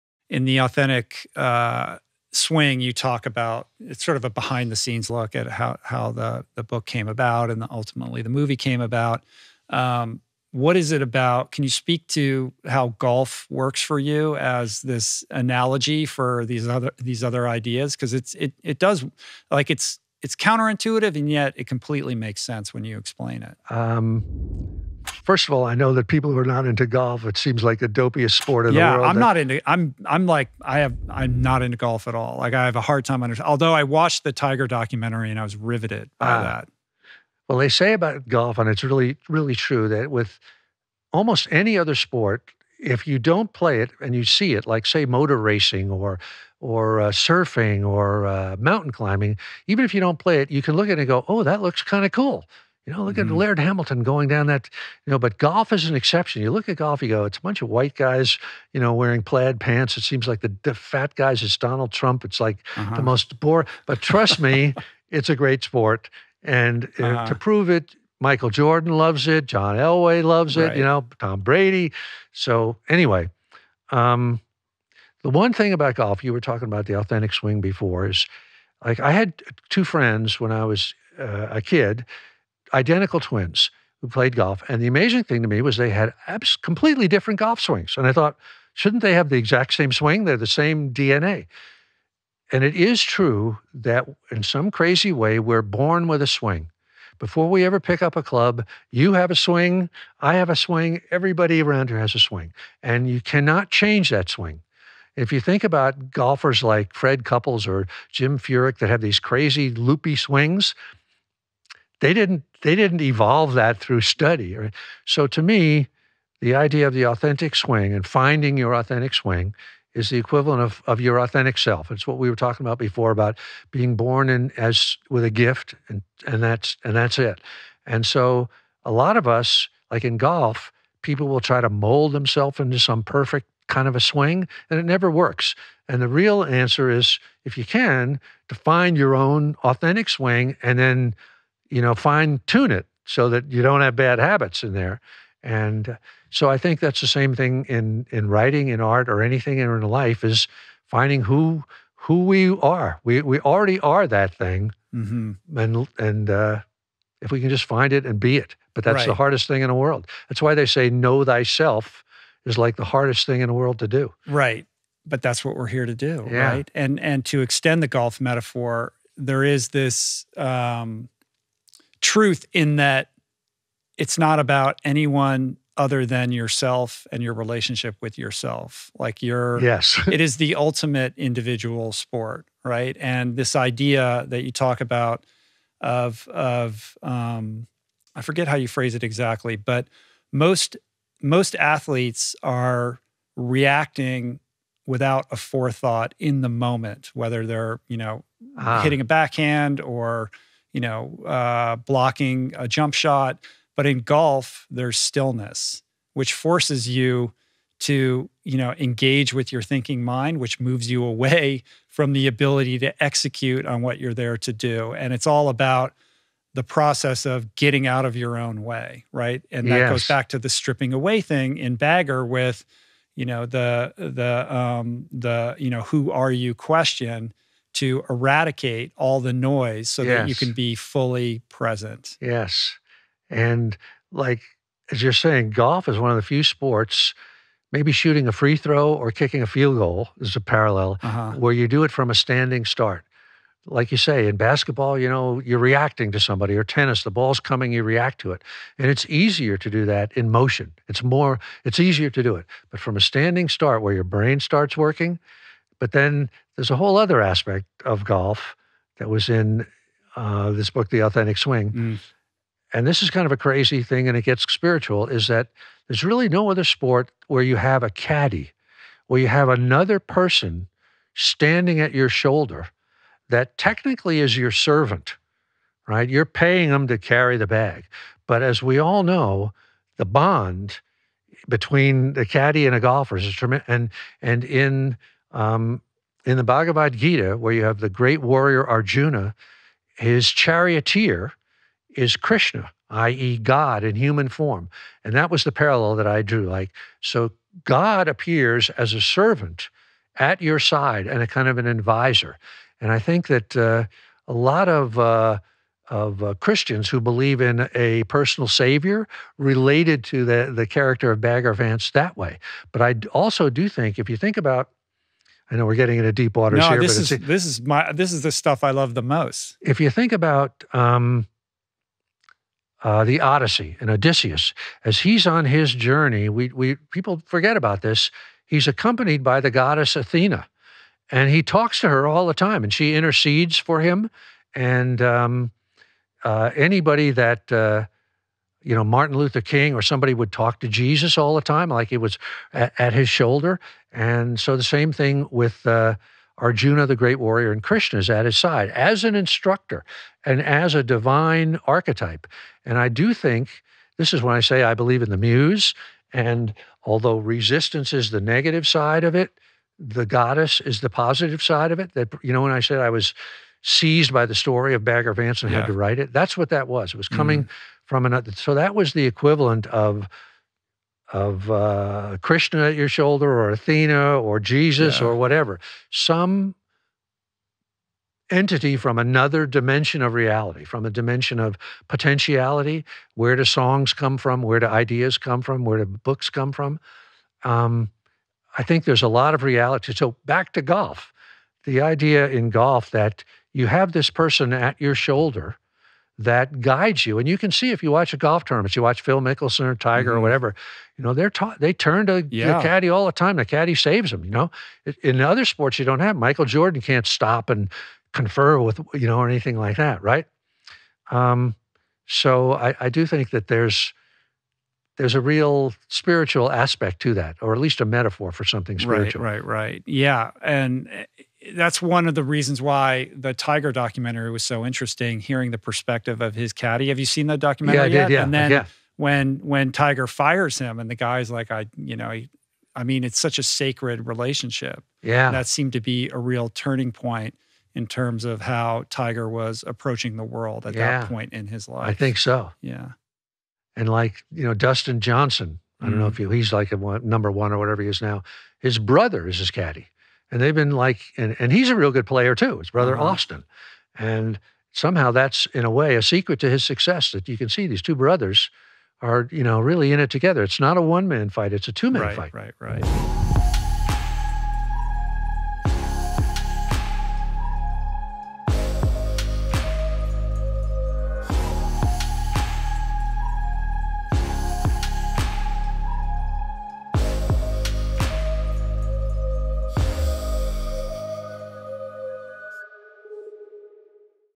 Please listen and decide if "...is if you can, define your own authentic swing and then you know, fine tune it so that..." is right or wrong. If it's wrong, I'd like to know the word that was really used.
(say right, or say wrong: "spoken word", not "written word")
right.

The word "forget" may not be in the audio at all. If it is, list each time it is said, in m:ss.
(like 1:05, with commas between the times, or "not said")
3:08, 5:27.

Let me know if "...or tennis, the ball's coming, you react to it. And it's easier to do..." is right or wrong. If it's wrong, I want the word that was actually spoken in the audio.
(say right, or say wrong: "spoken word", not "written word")
right.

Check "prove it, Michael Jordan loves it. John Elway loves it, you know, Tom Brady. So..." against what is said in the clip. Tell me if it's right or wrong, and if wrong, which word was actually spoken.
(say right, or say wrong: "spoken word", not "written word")
right.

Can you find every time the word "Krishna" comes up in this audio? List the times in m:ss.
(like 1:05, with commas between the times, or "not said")
4:52, 5:47, 6:12.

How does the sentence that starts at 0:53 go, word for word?
at Laird Hamilton going down that, you know, but golf is an exception.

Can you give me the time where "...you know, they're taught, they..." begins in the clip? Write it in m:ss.
6:40.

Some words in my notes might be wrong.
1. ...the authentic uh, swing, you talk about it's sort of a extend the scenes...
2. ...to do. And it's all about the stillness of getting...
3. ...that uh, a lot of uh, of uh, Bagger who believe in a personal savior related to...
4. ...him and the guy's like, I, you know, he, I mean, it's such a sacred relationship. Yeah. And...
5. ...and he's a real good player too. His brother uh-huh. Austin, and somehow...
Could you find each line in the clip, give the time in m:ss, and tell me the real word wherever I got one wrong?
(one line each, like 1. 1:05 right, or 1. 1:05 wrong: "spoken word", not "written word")
1. 0:00 wrong: "behind", not "extend"
2. 3:34 wrong: "process", not "stillness"
3. 5:03 wrong: "Christians", not "Bagger"
4. 7:10 right
5. 7:31 right.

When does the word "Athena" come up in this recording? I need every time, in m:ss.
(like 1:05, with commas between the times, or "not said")
5:29, 6:13.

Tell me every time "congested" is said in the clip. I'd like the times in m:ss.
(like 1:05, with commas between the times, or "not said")
not said.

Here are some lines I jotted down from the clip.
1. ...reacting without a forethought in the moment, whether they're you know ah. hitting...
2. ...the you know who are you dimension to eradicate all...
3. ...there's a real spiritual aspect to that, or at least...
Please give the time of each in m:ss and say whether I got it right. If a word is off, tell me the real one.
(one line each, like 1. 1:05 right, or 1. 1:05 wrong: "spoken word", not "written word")
1. 3:13 right
2. 3:45 wrong: "question", not "dimension"
3. 6:54 right.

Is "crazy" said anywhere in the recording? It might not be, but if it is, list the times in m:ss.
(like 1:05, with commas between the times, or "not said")
1:34, 1:49, 4:23.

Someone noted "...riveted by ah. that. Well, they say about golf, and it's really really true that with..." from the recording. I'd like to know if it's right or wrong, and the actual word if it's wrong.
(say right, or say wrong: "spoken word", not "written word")
right.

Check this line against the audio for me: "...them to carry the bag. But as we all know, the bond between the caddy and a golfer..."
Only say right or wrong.
right.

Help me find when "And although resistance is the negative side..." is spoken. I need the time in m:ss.
5:56.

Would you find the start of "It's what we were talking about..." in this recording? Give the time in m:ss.
2:01.